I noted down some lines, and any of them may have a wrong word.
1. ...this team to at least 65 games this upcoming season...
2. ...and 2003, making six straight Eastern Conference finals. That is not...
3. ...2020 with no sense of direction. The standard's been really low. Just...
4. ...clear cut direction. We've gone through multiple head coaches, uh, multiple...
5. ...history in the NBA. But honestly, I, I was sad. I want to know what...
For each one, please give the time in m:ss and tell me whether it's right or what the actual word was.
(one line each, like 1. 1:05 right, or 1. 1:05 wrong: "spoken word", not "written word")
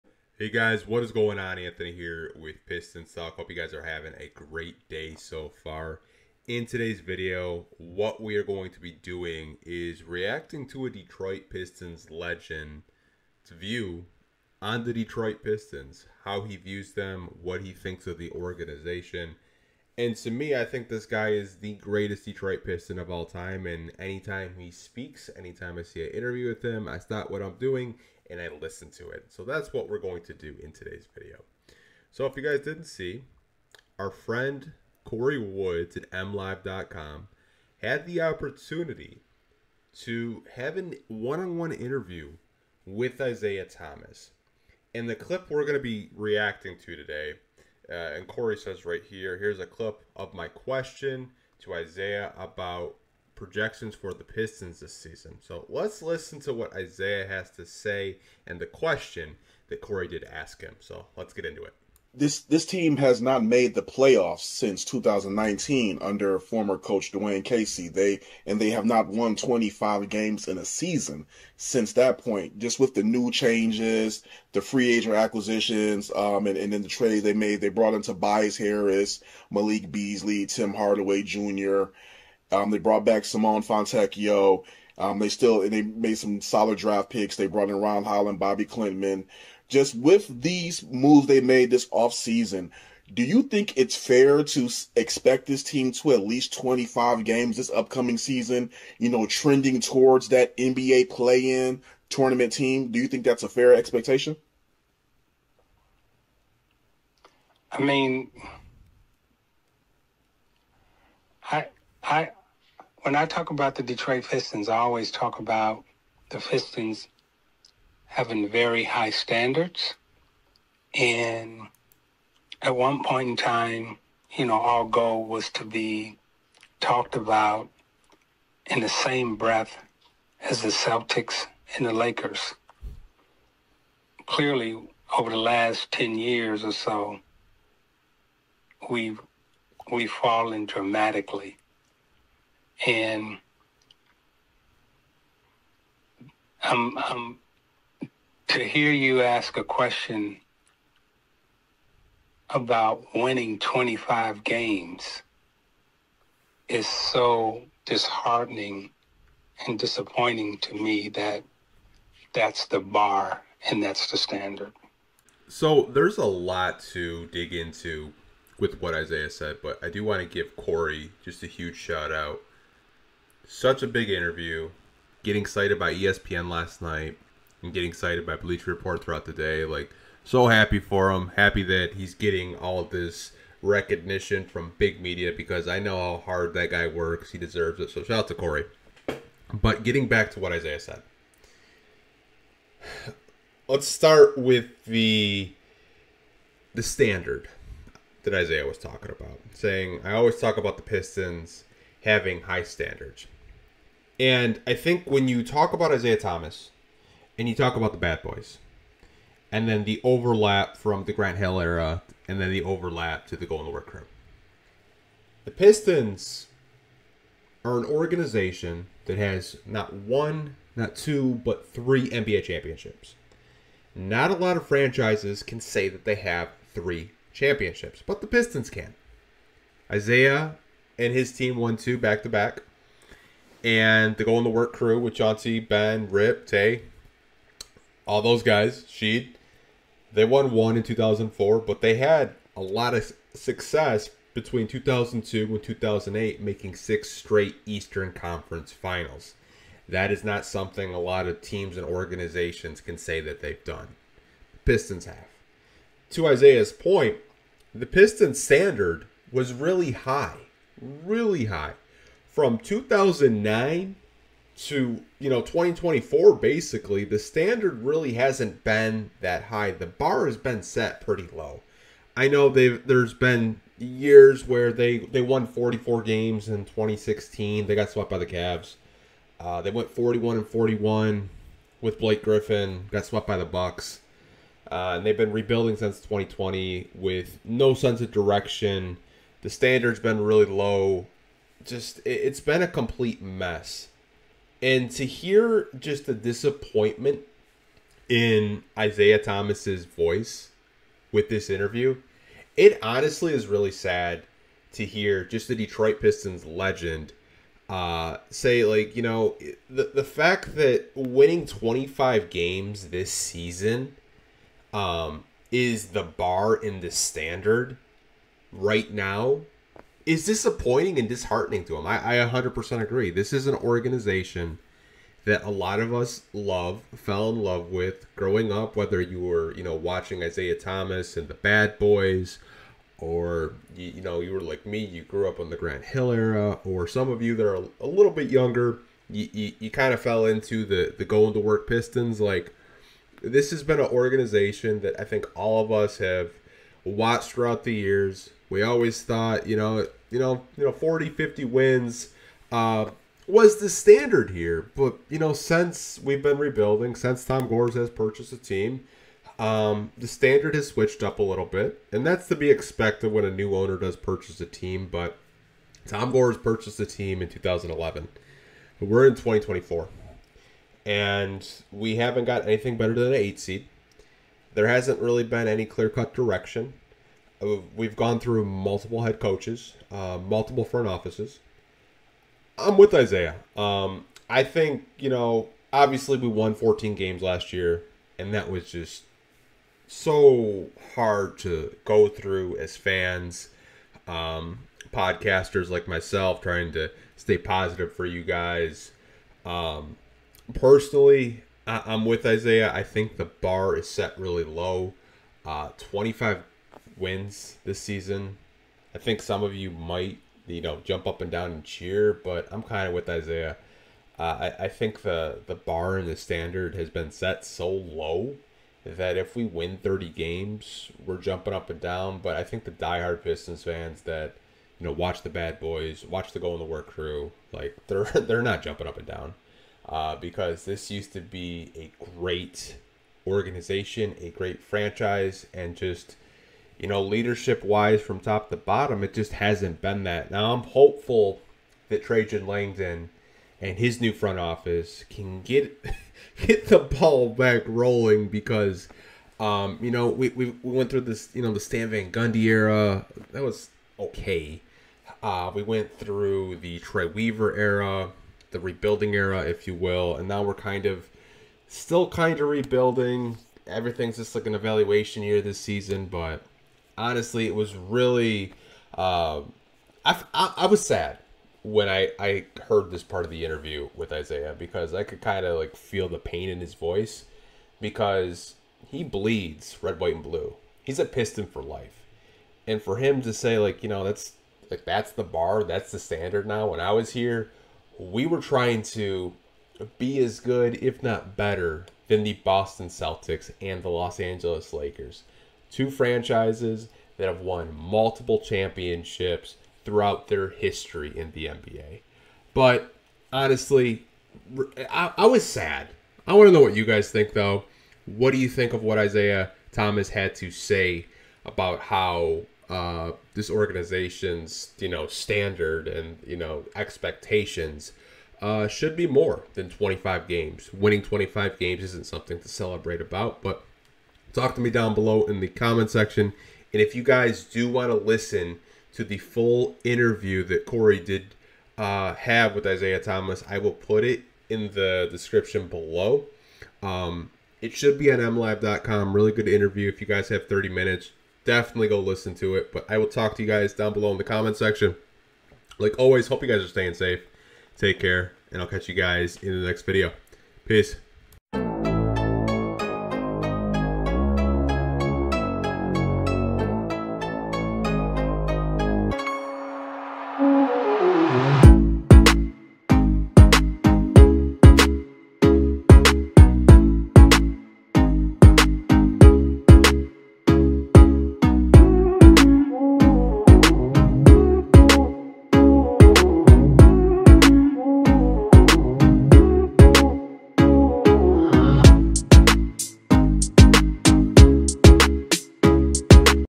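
1. 1:35 wrong: "25", not "65"
2. 4:05 wrong: "2008", not "2003"
3. 4:45 right
4. 6:15 right
5. 8:20 right.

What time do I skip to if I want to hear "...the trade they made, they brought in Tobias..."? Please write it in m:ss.
1:16.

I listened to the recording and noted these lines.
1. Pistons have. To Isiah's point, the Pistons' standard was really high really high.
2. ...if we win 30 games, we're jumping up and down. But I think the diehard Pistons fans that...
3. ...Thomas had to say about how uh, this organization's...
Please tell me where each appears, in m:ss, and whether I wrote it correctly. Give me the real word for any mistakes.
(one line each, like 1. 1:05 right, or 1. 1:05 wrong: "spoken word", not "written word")
1. 4:14 right
2. 6:59 right
3. 8:29 right.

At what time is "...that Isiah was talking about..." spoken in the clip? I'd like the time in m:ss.
3:18.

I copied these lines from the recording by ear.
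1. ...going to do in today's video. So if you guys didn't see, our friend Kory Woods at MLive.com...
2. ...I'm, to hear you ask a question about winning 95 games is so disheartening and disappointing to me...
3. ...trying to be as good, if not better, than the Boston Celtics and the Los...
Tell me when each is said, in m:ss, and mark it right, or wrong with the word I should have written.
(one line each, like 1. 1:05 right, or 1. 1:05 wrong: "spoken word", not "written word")
1. 0:29 right
2. 2:26 wrong: "25", not "95"
3. 8:08 right.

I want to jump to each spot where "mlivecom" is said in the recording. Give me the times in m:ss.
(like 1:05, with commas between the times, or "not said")
0:36, 8:58.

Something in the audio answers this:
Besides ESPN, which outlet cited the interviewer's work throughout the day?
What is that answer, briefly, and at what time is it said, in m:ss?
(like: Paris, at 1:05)
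Bleacher Report, at 2:58.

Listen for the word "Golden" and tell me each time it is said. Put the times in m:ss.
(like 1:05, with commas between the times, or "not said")
3:33, 3:54.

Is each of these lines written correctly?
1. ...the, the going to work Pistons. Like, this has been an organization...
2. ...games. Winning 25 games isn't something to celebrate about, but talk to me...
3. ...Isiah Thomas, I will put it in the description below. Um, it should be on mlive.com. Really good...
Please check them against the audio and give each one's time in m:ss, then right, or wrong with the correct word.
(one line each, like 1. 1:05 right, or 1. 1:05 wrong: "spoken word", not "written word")
1. 5:40 right
2. 8:40 right
3. 8:52 right.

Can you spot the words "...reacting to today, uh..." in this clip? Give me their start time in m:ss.
0:46.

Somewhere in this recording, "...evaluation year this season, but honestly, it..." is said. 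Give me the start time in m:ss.
7:44.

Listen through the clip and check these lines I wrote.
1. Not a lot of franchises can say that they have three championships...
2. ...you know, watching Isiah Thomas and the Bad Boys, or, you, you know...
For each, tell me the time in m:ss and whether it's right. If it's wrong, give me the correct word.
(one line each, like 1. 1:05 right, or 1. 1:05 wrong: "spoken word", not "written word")
1. 3:43 right
2. 5:29 right.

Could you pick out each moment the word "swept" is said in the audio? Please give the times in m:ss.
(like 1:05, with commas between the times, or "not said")
4:37, 4:43.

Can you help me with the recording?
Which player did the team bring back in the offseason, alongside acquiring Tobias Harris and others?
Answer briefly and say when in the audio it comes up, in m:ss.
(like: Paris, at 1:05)
Simone Fontecchio, at 1:23.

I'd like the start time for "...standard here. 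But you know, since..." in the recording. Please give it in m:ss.
5:53.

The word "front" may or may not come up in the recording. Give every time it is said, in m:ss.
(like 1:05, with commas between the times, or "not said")
6:20, 7:24.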